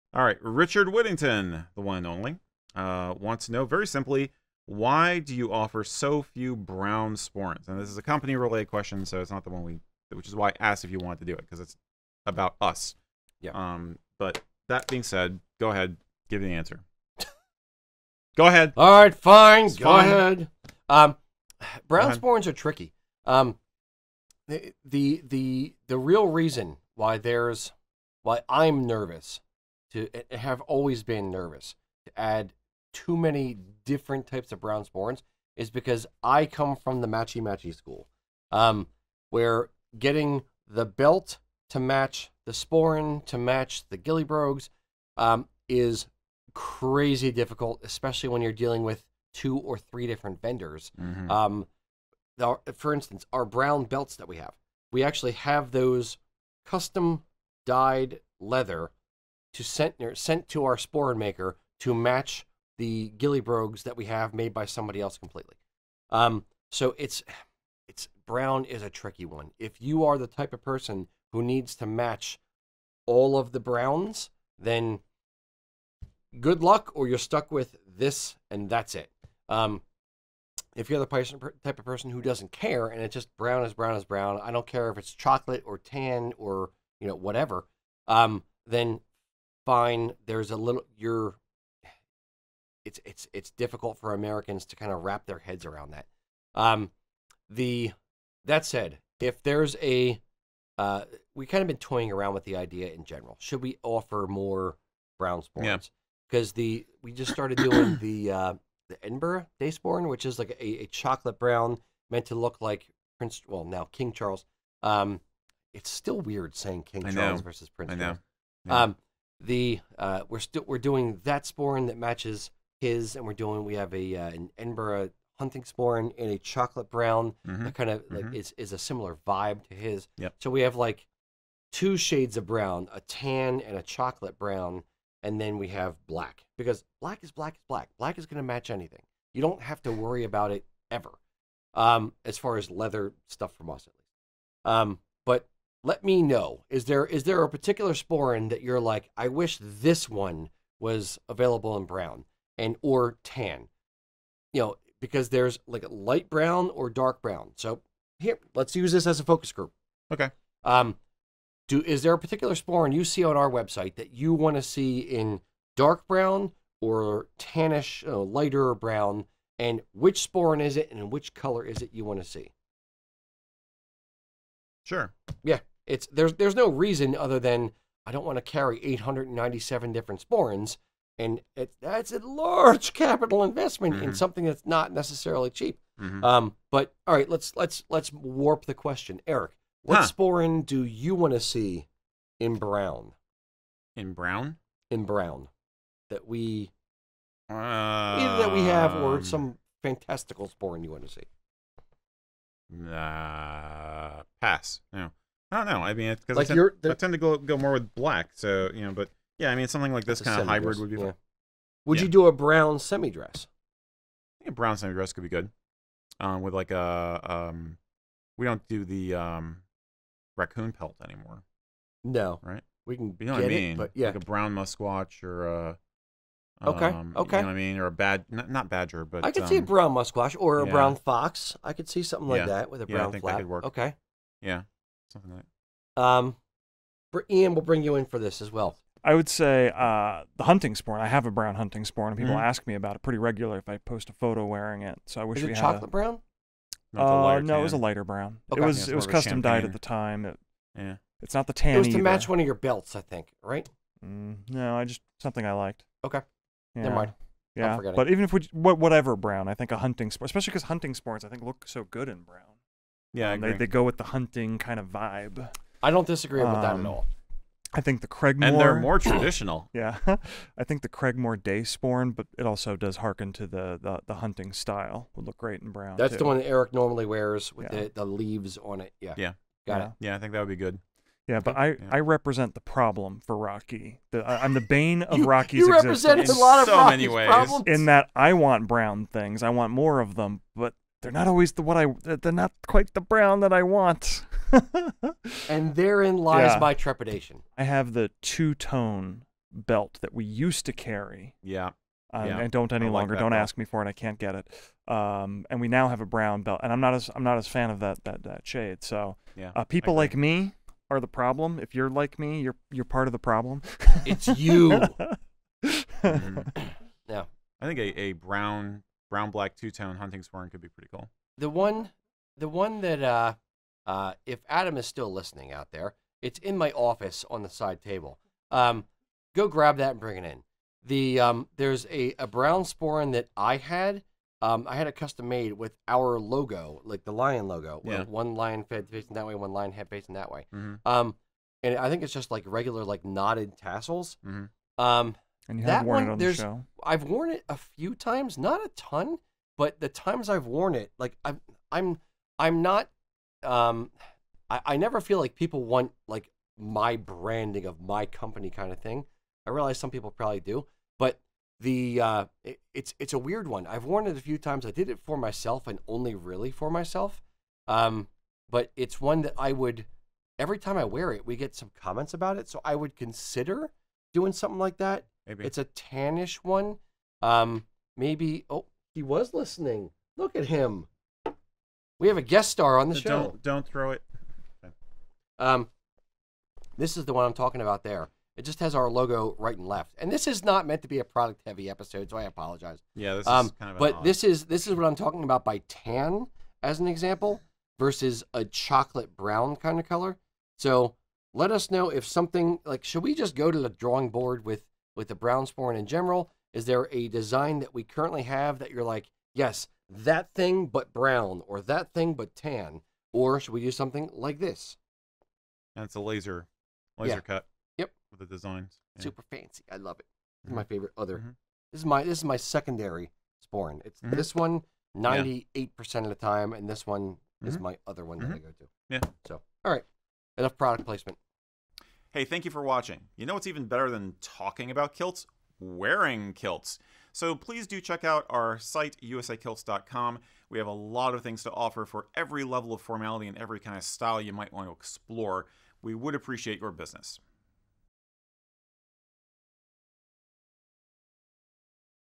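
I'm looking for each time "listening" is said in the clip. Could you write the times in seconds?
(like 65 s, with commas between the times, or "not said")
325 s, 379 s.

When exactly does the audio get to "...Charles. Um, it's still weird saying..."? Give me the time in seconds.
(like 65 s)
114 s.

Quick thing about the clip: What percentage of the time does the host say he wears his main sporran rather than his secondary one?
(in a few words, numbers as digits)
98%.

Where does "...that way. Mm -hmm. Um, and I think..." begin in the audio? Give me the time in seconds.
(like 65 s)
340 s.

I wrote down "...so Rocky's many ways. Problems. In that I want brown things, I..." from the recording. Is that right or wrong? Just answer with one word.
right.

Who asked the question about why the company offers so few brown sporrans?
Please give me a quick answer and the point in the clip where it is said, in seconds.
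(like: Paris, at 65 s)
Richard Whittington, at 0 s.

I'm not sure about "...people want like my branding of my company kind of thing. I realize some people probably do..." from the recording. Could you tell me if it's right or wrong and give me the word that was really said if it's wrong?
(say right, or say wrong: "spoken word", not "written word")
right.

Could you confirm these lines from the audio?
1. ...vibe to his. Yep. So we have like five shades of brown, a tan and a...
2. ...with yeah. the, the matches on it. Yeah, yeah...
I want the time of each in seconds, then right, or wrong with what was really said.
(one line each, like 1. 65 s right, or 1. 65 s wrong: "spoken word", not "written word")
1. 129 s wrong: "two", not "five"
2. 277 s wrong: "leaves", not "matches".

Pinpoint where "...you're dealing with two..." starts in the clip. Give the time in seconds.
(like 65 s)
48 s.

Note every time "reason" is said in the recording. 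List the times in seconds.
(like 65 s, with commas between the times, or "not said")
26 s, 176 s.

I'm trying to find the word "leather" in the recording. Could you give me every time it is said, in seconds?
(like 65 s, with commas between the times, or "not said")
58 s, 142 s.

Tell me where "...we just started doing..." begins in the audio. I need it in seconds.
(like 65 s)
107 s.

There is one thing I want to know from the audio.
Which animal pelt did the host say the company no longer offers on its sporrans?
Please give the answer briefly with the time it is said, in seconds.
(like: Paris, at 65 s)
raccoon, at 220 s.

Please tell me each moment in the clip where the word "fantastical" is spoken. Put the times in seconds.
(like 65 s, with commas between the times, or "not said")
199 s.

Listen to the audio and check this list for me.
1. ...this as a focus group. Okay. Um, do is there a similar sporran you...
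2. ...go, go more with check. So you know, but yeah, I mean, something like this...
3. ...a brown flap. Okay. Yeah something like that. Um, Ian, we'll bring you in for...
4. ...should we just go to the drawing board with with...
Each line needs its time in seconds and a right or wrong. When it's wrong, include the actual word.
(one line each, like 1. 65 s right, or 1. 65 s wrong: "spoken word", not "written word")
1. 158 s wrong: "particular", not "similar"
2. 207 s wrong: "black", not "check"
3. 232 s right
4. 402 s right.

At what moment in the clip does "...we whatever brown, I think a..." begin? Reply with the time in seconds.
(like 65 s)
258 s.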